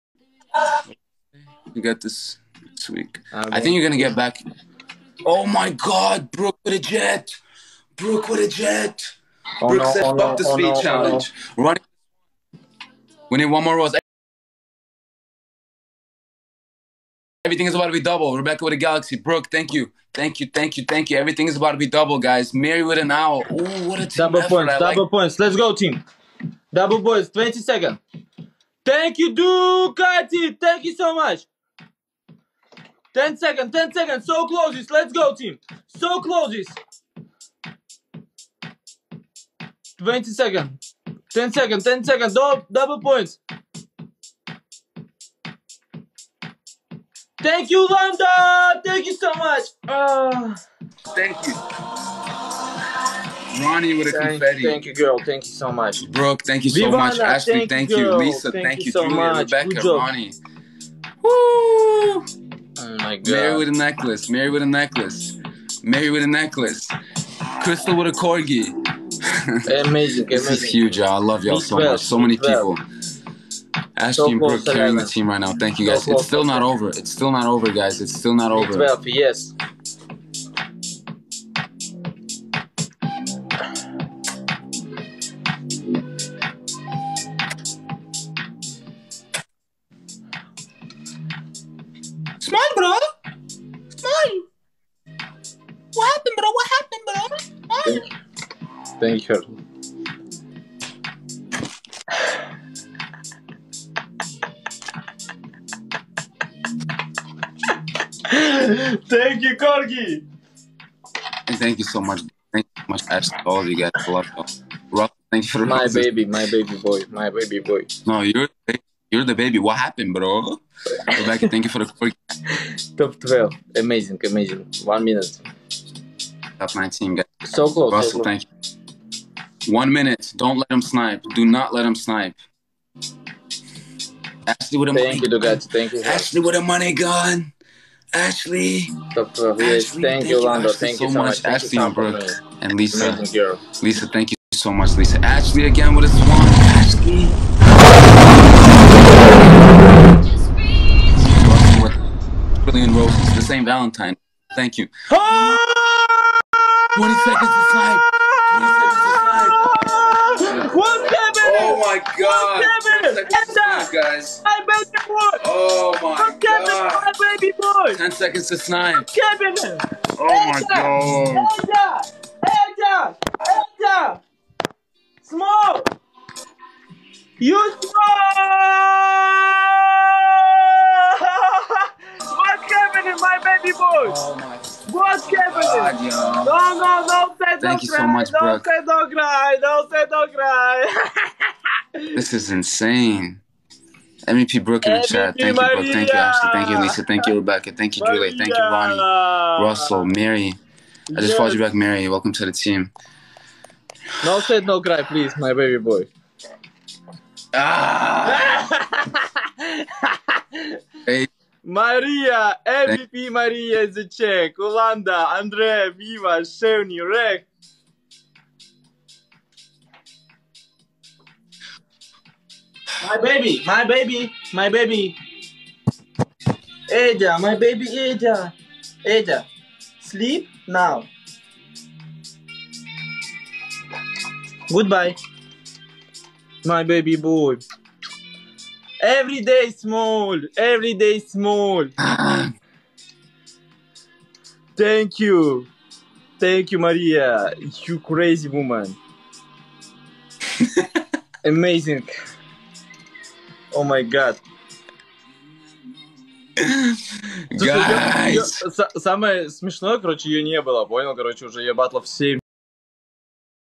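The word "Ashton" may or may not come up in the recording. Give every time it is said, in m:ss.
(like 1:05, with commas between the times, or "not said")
1:13.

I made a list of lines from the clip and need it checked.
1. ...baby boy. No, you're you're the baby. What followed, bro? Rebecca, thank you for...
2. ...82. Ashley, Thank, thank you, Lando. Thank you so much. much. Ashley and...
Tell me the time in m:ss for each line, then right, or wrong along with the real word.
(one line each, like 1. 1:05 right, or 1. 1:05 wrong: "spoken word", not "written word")
1. 1:57 wrong: "happened", not "followed"
2. 2:19 wrong: "12", not "82".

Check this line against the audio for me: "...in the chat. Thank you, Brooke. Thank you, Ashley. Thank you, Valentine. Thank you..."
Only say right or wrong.
wrong.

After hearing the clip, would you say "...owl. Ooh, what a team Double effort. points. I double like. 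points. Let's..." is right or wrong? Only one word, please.
right.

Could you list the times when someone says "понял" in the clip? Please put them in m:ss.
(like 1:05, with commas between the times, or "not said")
4:20.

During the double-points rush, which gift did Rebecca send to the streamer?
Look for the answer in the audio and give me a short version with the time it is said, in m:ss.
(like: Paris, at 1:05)
Galaxy, at 0:18.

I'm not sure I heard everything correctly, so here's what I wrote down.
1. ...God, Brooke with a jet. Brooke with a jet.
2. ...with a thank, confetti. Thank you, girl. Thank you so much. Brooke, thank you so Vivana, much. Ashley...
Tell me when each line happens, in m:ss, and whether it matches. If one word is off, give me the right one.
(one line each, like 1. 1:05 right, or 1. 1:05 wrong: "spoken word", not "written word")
1. 0:05 right
2. 0:53 right.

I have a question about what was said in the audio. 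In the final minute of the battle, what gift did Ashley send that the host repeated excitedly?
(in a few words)
Money gun.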